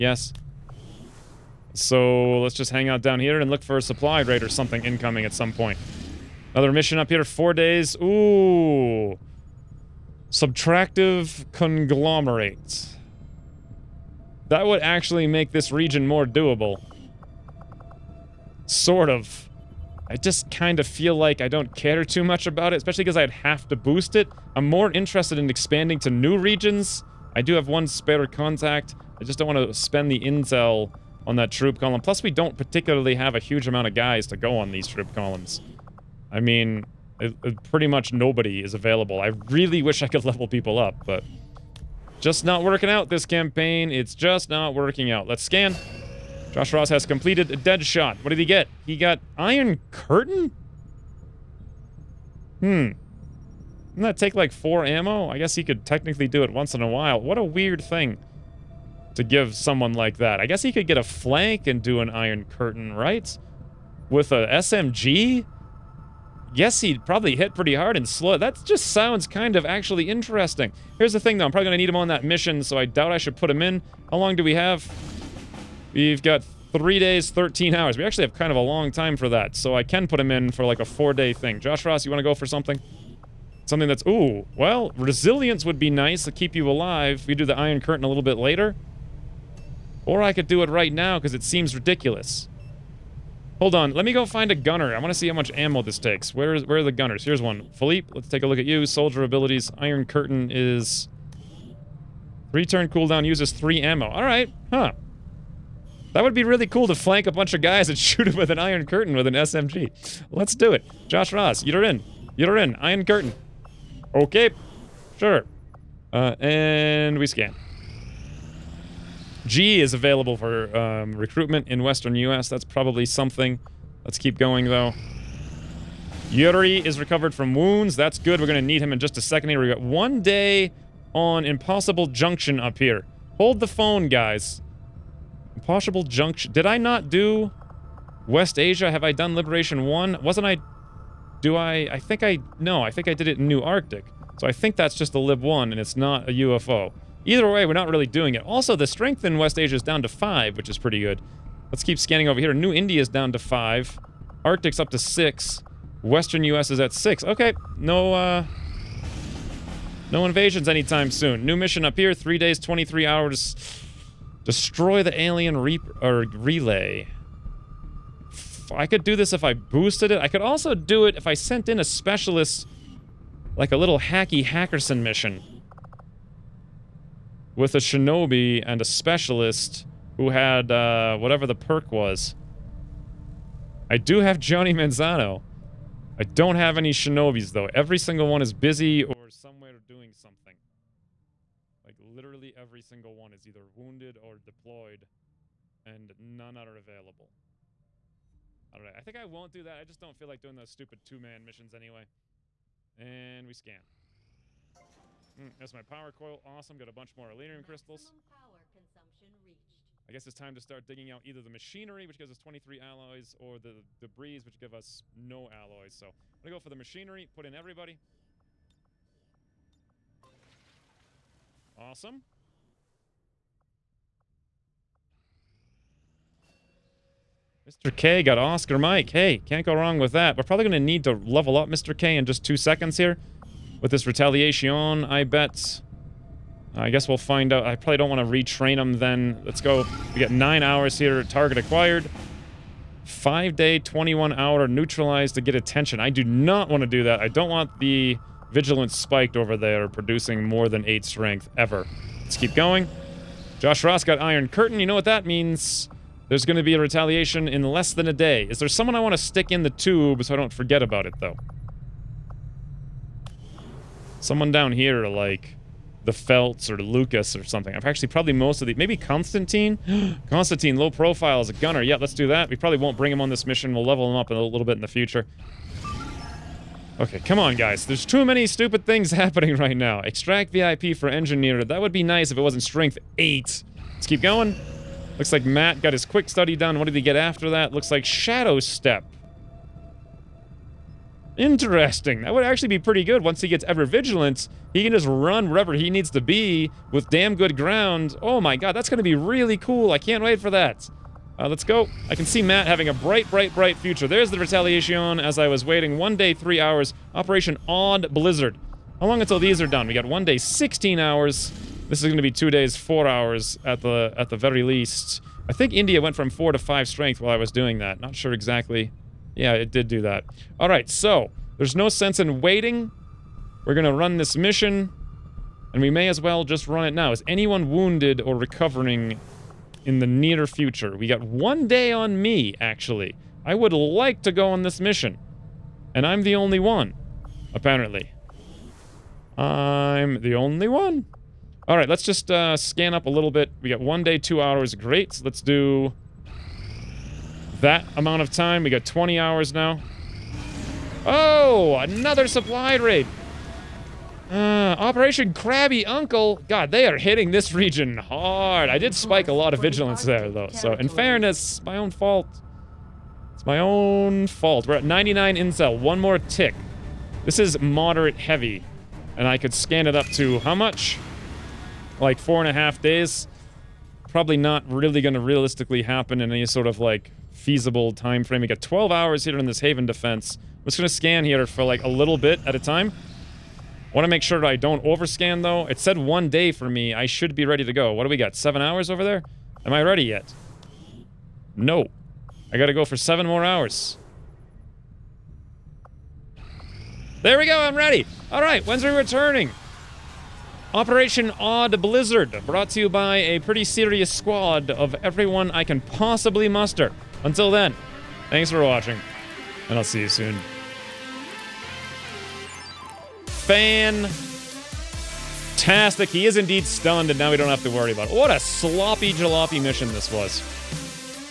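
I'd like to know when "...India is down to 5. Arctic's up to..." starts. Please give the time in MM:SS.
02:32.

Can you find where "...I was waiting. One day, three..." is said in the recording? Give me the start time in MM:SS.
05:05.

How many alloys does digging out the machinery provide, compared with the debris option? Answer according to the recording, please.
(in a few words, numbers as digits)
23.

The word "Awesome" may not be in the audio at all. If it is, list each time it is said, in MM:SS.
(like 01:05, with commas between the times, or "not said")
03:26, 03:41.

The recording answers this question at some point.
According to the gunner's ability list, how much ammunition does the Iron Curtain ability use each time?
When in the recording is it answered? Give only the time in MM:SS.
01:43.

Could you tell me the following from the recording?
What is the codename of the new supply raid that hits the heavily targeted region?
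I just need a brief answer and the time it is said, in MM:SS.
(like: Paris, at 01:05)
Operation Crabby Uncle, at 05:54.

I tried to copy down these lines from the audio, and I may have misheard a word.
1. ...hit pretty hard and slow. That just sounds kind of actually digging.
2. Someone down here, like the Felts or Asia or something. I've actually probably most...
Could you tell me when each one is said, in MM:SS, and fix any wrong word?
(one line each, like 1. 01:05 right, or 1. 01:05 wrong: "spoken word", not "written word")
1. 01:07 wrong: "interesting", not "digging"
2. 04:24 wrong: "Lucas", not "Asia".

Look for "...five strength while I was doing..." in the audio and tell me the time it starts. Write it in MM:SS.
05:16.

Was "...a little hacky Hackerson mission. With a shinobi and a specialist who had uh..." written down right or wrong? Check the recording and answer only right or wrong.
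right.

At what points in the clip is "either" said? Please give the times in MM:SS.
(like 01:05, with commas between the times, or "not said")
02:27, 03:13, 03:31.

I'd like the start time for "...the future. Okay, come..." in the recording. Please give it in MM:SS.
04:34.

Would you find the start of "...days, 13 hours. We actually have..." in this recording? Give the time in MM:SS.
01:16.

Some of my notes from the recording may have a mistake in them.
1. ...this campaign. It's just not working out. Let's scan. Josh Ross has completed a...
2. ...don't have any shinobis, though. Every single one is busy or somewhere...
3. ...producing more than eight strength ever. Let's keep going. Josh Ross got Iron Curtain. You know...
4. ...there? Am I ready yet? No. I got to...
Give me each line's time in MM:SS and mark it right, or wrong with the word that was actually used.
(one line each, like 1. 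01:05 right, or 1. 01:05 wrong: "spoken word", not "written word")
1. 00:43 right
2. 03:06 right
3. 04:09 right
4. 06:29 right.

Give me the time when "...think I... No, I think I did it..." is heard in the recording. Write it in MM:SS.
02:21.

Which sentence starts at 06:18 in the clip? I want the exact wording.
We got 12 hours here in this Haven defense.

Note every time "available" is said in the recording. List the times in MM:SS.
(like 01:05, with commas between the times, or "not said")
00:38, 01:59, 03:16.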